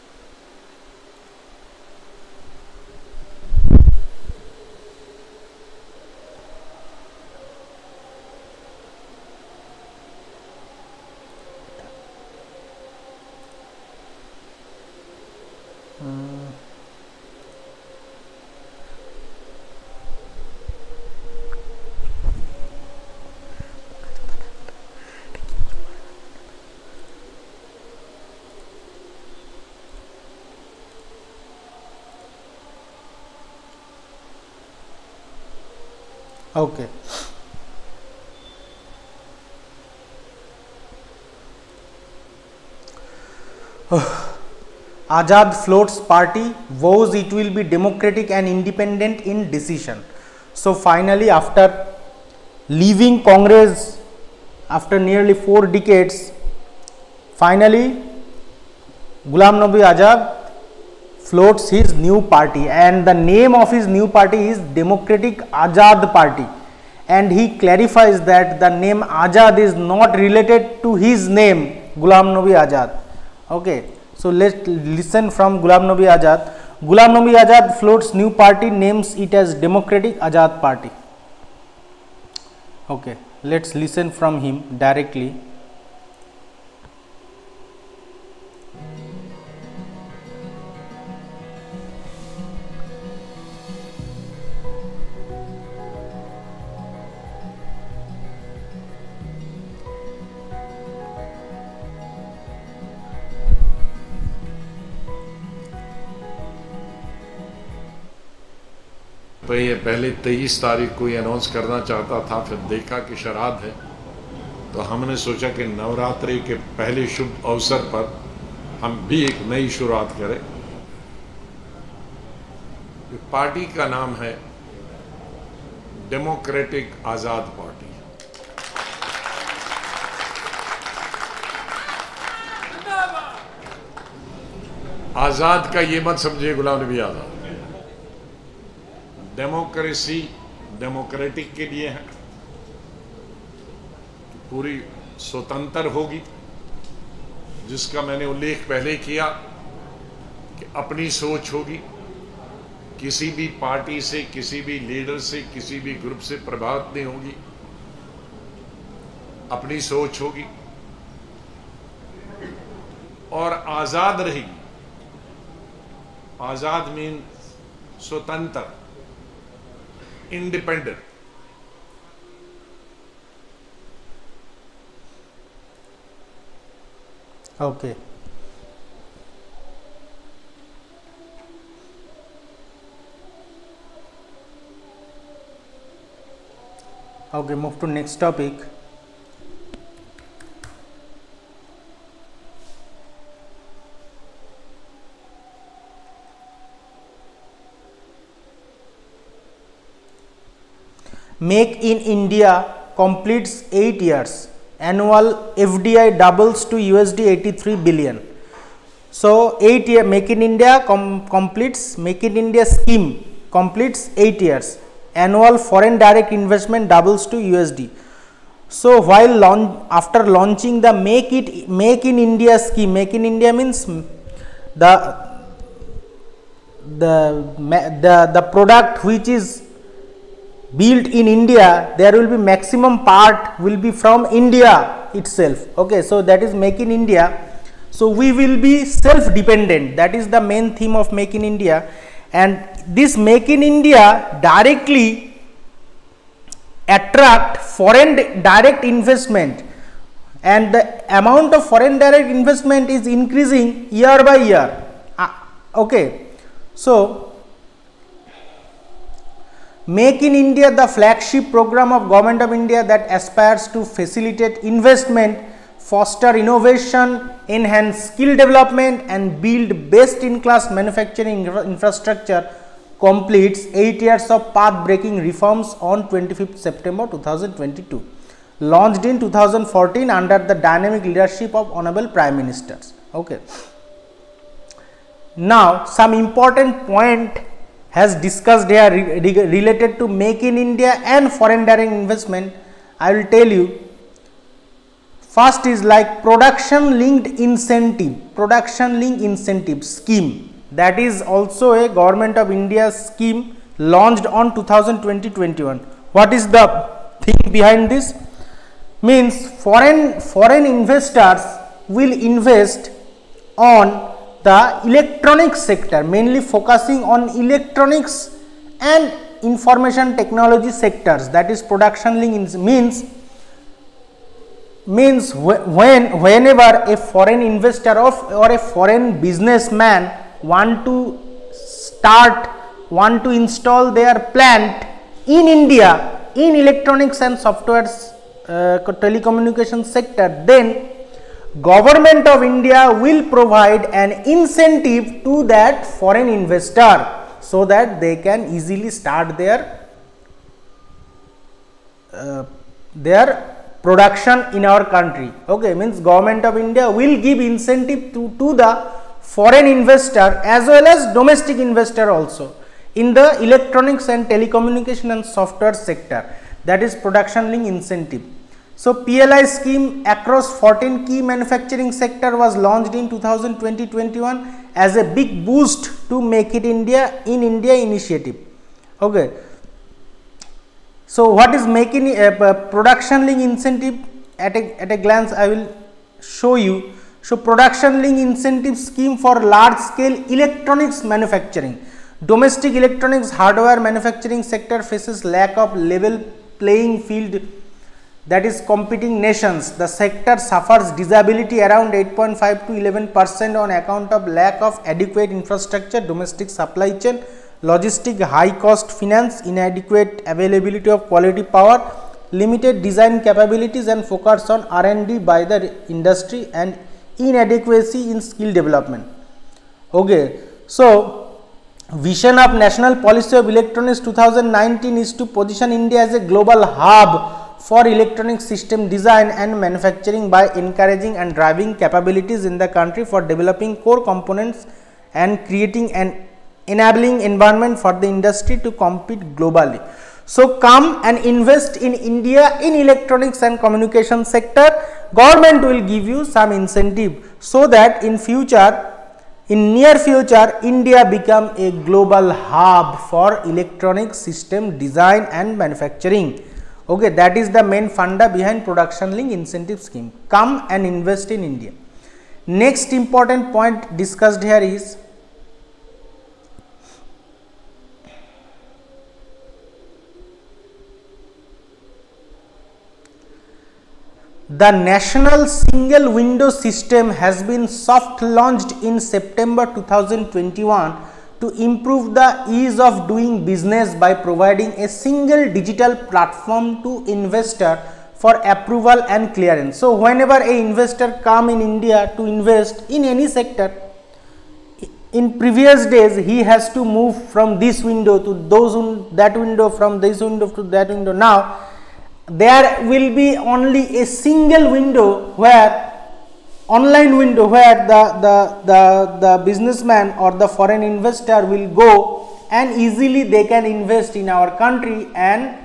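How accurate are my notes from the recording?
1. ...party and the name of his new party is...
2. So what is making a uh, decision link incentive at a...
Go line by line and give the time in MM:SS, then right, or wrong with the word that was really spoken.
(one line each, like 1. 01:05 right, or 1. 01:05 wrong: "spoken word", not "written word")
1. 01:02 right
2. 06:21 wrong: "production", not "decision".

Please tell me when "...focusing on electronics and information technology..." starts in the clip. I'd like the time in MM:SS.
05:16.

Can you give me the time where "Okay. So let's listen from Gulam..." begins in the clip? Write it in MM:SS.
01:13.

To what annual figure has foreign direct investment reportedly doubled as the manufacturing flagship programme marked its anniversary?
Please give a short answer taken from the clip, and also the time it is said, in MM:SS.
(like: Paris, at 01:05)
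USD 83 billion, at 03:26.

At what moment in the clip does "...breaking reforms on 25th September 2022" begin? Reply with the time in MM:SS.
04:34.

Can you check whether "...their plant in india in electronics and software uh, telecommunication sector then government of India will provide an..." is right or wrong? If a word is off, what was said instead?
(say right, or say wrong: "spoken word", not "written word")
right.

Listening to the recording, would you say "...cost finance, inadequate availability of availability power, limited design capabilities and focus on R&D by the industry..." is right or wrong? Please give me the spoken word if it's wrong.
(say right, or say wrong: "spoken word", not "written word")
wrong: "quality", not "availability".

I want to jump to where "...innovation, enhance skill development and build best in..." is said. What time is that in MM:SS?
04:26.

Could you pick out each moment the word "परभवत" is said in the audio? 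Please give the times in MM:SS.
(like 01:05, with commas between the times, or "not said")
02:36.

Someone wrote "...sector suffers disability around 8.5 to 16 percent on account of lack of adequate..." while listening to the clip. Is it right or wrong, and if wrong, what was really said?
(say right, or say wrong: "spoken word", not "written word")
wrong: "11", not "16".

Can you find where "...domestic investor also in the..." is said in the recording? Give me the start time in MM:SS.
06:01.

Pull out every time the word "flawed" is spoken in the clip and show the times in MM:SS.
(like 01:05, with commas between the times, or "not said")
not said.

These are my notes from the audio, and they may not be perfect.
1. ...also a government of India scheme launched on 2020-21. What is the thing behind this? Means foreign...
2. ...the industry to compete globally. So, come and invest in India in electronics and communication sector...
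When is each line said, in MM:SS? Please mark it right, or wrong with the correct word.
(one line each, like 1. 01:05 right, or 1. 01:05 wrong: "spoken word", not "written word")
1. 05:01 right
2. 07:18 right.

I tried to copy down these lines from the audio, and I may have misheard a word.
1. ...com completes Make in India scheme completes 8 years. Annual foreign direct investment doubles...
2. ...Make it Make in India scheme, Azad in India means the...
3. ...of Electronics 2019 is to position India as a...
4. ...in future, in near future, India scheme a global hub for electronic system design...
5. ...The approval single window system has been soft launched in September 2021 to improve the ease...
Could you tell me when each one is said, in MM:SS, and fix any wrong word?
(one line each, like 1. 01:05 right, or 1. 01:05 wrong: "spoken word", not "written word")
1. 03:30 right
2. 03:40 wrong: "Make", not "Azad"
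3. 07:03 right
4. 07:28 wrong: "become", not "scheme"
5. 07:54 wrong: "national", not "approval".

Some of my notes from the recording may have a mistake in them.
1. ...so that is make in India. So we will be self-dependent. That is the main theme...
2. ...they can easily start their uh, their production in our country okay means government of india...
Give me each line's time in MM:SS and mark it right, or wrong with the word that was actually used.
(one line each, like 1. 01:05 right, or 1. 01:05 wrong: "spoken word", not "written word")
1. 03:56 right
2. 05:48 right.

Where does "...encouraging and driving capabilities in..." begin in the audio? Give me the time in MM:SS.
07:10.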